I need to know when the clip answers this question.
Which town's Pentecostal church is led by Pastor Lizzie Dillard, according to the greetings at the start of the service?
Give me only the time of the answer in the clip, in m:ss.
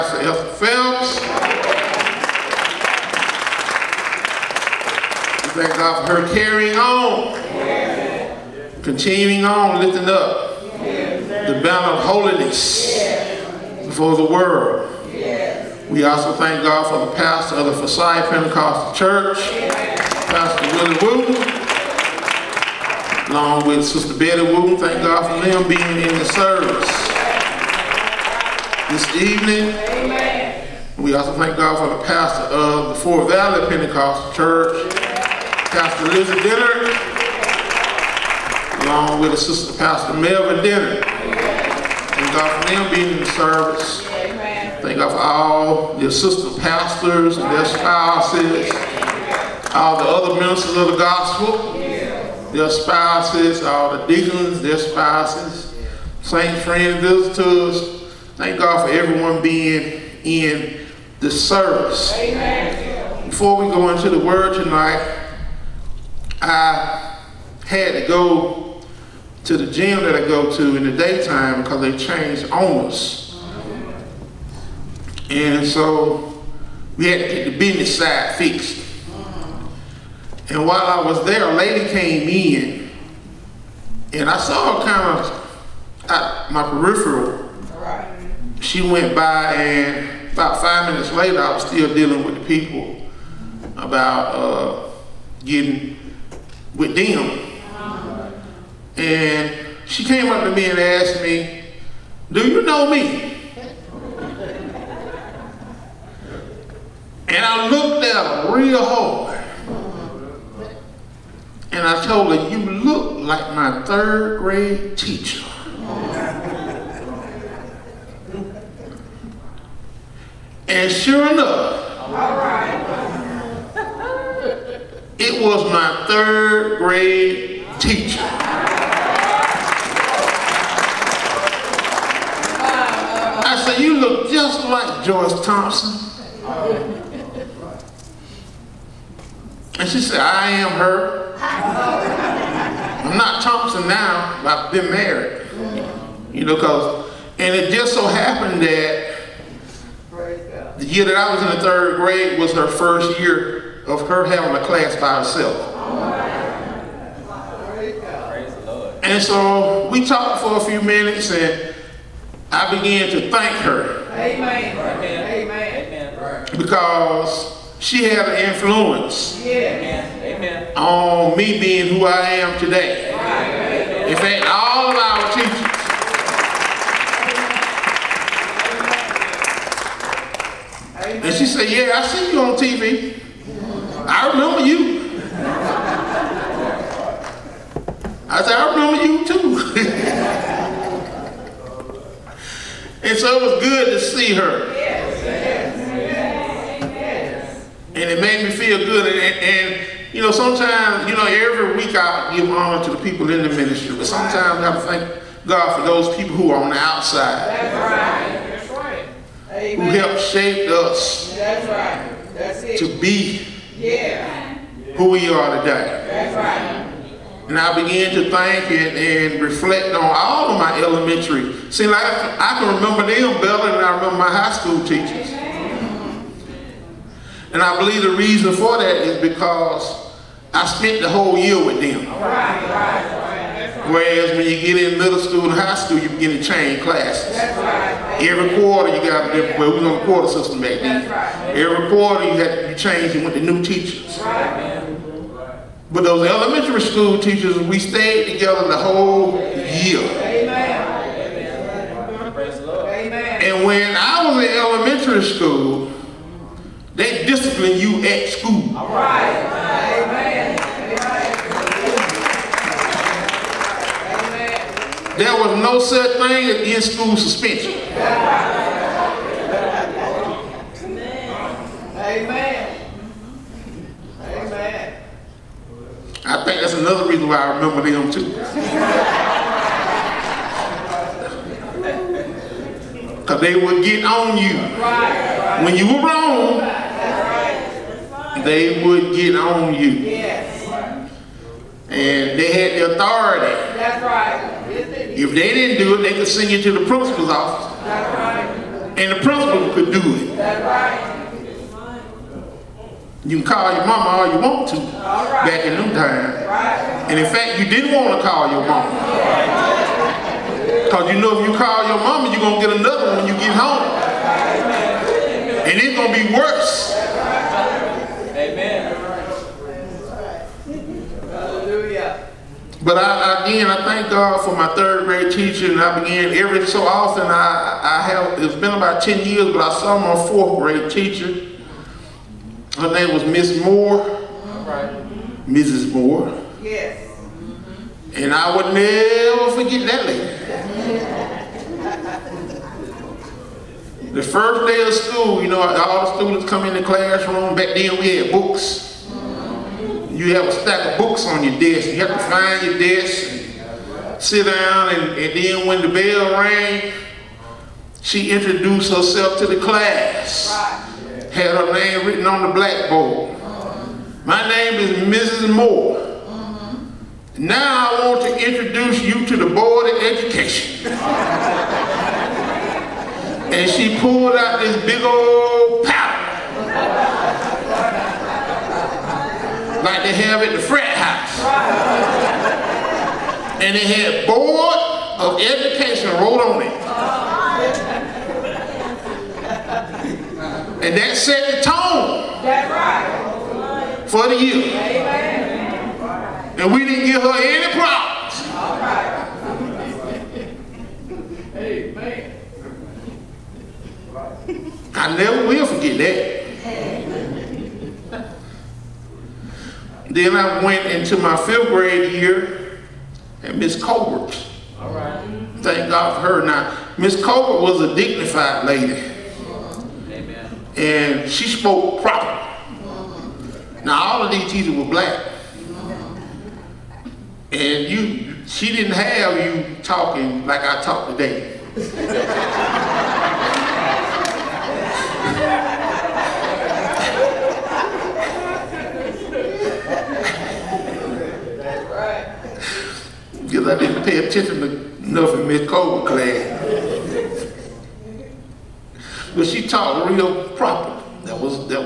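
0:32.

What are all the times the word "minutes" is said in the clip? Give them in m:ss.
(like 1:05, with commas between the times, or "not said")
1:30, 2:40.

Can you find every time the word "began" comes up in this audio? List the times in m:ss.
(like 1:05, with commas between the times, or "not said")
2:42, 3:37, 5:25.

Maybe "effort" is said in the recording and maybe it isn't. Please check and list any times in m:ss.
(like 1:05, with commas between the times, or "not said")
not said.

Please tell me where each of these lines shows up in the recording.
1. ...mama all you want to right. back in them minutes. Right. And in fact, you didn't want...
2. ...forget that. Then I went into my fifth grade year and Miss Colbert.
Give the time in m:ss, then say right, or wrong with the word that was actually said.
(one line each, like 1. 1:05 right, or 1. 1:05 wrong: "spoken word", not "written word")
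1. 5:03 wrong: "times", not "minutes"
2. 6:45 right.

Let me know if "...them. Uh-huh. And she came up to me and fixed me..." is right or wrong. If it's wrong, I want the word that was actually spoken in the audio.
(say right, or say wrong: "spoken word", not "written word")
wrong: "asked", not "fixed".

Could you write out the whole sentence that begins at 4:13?
And when I was in elementary school, they discipline you at school.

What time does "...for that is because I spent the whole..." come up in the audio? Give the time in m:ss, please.
3:48.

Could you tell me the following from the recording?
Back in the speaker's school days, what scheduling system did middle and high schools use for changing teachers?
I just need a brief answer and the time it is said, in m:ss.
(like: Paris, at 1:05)
Quarter system, at 4:00.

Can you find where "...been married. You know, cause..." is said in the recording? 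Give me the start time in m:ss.
2:24.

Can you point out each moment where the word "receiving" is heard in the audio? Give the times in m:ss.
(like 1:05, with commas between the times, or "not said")
not said.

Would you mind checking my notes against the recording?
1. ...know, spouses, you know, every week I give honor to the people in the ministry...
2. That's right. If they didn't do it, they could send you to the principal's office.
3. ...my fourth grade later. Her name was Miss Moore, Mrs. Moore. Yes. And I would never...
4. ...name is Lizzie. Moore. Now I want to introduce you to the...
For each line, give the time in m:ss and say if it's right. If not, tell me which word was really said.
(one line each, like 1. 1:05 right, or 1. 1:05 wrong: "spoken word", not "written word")
1. 3:20 wrong: "sometimes", not "spouses"
2. 4:53 right
3. 5:29 wrong: "teacher", not "later"
4. 6:04 wrong: "Mrs", not "Lizzie".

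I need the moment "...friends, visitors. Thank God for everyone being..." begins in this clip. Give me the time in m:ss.
0:56.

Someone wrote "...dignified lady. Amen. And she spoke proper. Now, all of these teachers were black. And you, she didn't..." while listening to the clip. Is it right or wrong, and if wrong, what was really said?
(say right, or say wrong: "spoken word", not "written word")
right.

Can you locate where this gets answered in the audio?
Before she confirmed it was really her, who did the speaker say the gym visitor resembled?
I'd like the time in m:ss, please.
2:15.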